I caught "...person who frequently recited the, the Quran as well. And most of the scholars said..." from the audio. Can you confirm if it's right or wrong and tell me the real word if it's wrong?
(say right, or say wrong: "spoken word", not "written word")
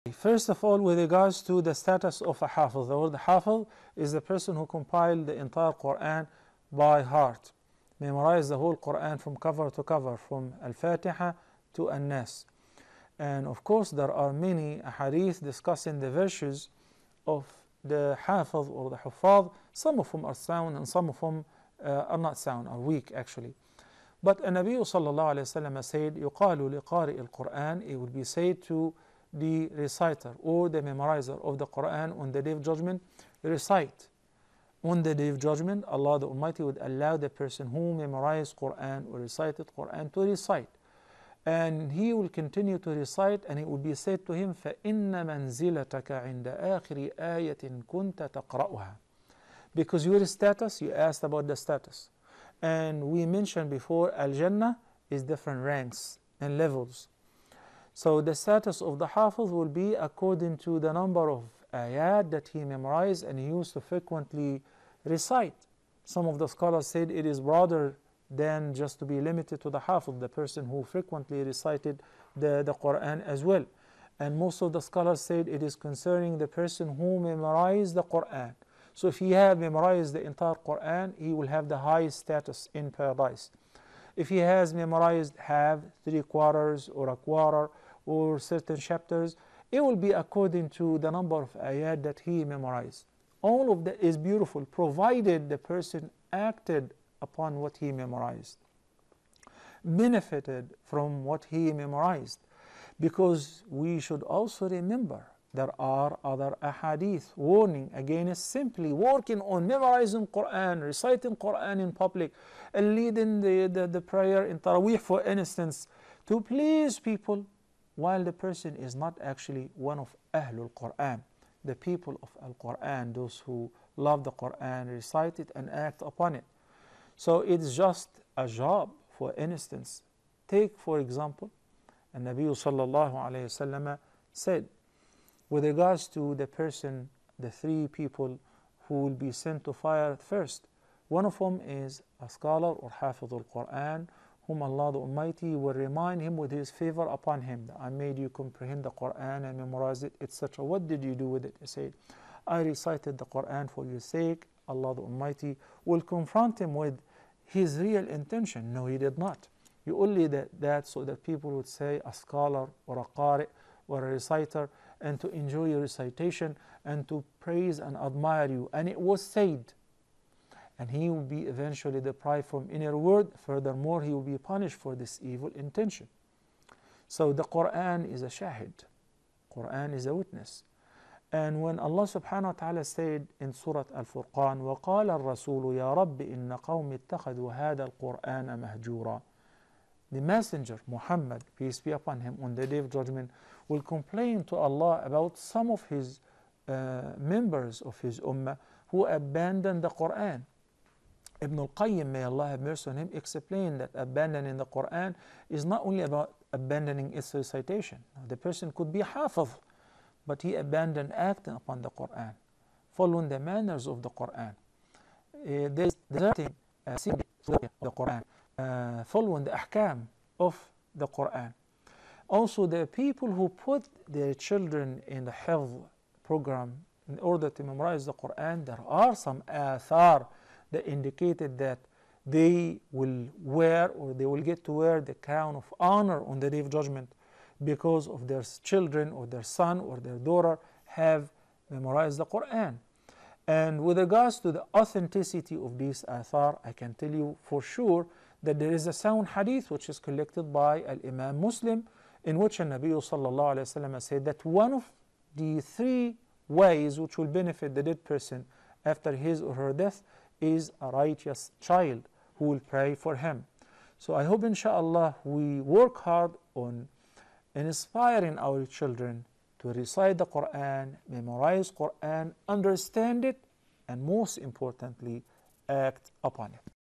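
right.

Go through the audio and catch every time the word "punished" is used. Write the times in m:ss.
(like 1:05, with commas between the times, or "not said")
2:54.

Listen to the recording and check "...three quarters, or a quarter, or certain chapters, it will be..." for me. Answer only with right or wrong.
right.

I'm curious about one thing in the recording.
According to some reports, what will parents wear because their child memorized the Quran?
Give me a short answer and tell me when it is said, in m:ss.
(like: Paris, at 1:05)
Crown of honor, at 3:55.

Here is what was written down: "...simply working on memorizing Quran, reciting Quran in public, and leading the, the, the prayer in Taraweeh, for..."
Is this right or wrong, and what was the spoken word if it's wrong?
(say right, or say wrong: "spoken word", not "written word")
right.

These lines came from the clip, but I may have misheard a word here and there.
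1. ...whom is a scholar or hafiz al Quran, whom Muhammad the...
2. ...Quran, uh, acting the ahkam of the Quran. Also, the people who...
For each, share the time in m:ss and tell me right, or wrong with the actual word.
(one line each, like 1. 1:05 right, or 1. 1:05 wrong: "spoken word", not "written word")
1. 2:21 wrong: "Allah", not "Muhammad"
2. 3:37 wrong: "following", not "acting".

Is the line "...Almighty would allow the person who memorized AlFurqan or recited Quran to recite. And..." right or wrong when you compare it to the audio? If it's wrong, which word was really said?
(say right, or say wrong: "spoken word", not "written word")
wrong: "Quran", not "AlFurqan".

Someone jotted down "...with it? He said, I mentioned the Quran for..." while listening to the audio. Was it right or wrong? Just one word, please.
wrong.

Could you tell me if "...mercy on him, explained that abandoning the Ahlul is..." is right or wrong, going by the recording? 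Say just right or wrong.
wrong.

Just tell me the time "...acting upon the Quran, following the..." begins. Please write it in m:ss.
3:31.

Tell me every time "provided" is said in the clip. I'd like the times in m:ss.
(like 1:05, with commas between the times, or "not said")
1:34.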